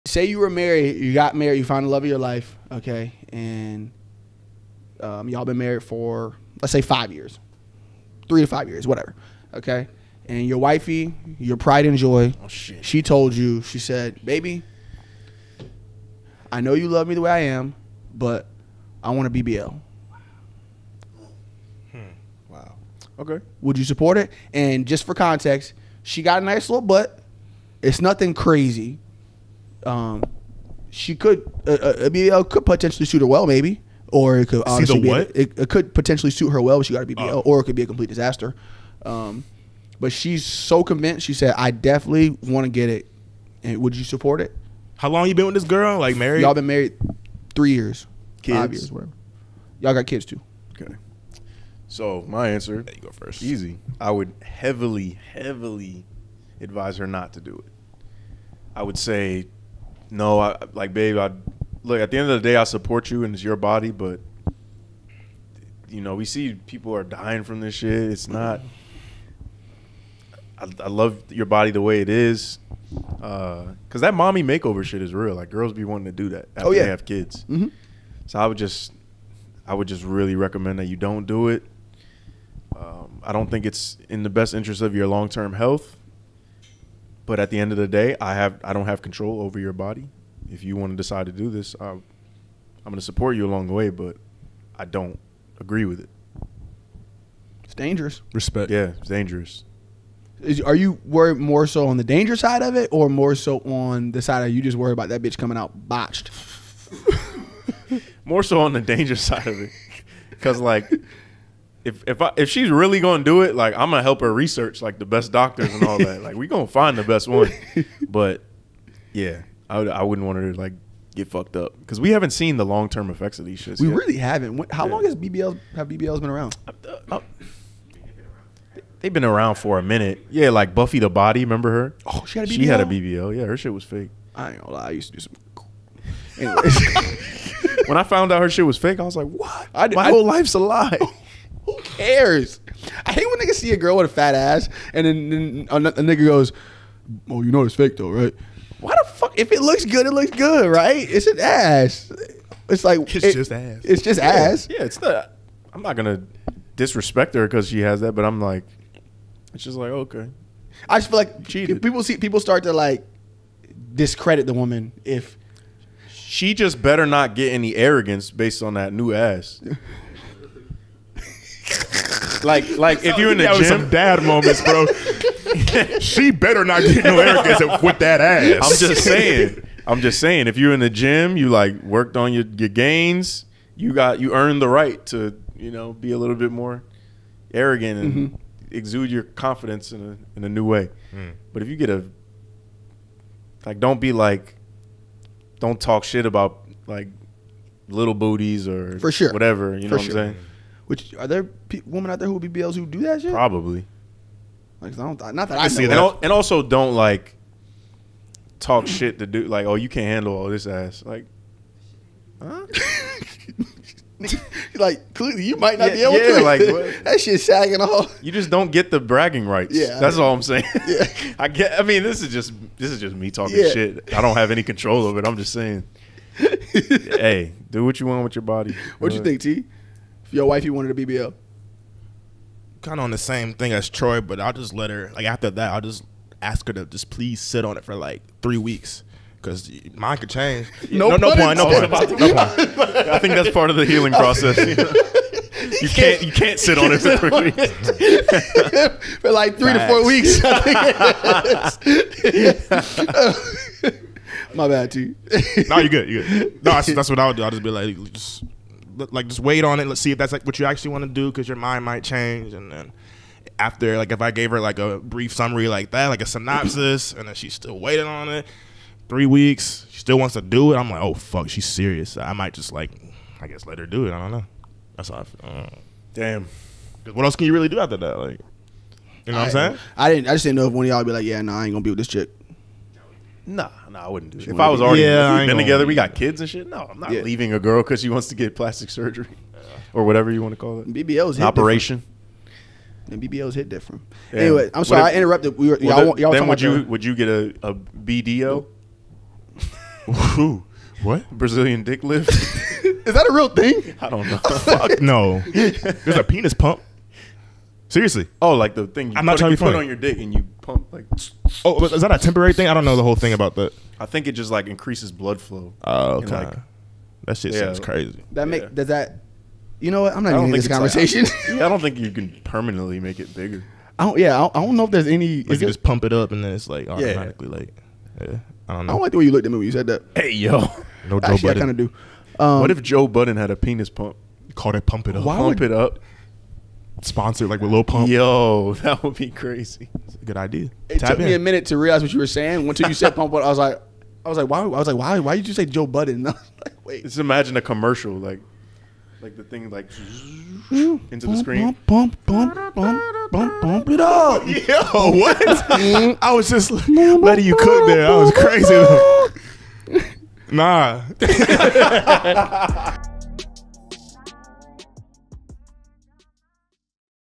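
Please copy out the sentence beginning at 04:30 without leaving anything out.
I'm like, oh fuck, she's serious.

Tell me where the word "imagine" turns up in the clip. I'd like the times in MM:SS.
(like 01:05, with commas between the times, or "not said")
05:47.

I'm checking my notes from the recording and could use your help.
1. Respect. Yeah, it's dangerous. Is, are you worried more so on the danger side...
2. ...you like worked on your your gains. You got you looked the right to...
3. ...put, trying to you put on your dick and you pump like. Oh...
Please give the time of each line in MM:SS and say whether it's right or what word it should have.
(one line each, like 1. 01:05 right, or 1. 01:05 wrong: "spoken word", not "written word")
1. 01:38 right
2. 03:01 wrong: "earned", not "looked"
3. 05:09 right.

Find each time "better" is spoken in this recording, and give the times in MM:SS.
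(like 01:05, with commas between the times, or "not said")
02:46, 02:56.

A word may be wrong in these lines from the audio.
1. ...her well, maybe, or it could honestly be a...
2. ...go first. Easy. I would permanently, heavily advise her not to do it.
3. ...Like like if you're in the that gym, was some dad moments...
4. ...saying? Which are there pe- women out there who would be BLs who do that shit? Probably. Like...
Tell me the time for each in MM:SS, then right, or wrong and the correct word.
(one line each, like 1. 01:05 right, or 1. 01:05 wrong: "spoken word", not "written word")
1. 00:33 right
2. 00:53 wrong: "heavily", not "permanently"
3. 02:52 right
4. 03:20 right.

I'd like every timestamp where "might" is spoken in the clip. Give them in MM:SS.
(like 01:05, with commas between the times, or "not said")
03:35, 04:21, 04:32.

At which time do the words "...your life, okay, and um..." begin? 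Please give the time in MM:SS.
00:02.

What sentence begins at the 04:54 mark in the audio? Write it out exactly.
Anyway, I'm sorry if, I interrupted.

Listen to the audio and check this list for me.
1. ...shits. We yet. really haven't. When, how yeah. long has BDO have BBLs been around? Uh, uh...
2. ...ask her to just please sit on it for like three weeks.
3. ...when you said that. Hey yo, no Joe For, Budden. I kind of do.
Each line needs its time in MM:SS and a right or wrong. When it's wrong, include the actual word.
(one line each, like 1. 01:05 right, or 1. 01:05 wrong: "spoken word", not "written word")
1. 02:03 wrong: "BBL", not "BDO"
2. 03:56 right
3. 05:29 wrong: "Actually", not "For".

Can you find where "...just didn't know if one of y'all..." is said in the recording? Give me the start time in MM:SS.
04:40.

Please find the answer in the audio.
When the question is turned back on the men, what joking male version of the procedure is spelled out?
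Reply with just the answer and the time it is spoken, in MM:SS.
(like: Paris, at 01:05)
Brazilian dick lift, at 05:01.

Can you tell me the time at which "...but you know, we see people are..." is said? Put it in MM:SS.
01:03.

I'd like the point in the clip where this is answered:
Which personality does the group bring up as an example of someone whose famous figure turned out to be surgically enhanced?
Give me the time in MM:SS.
02:10.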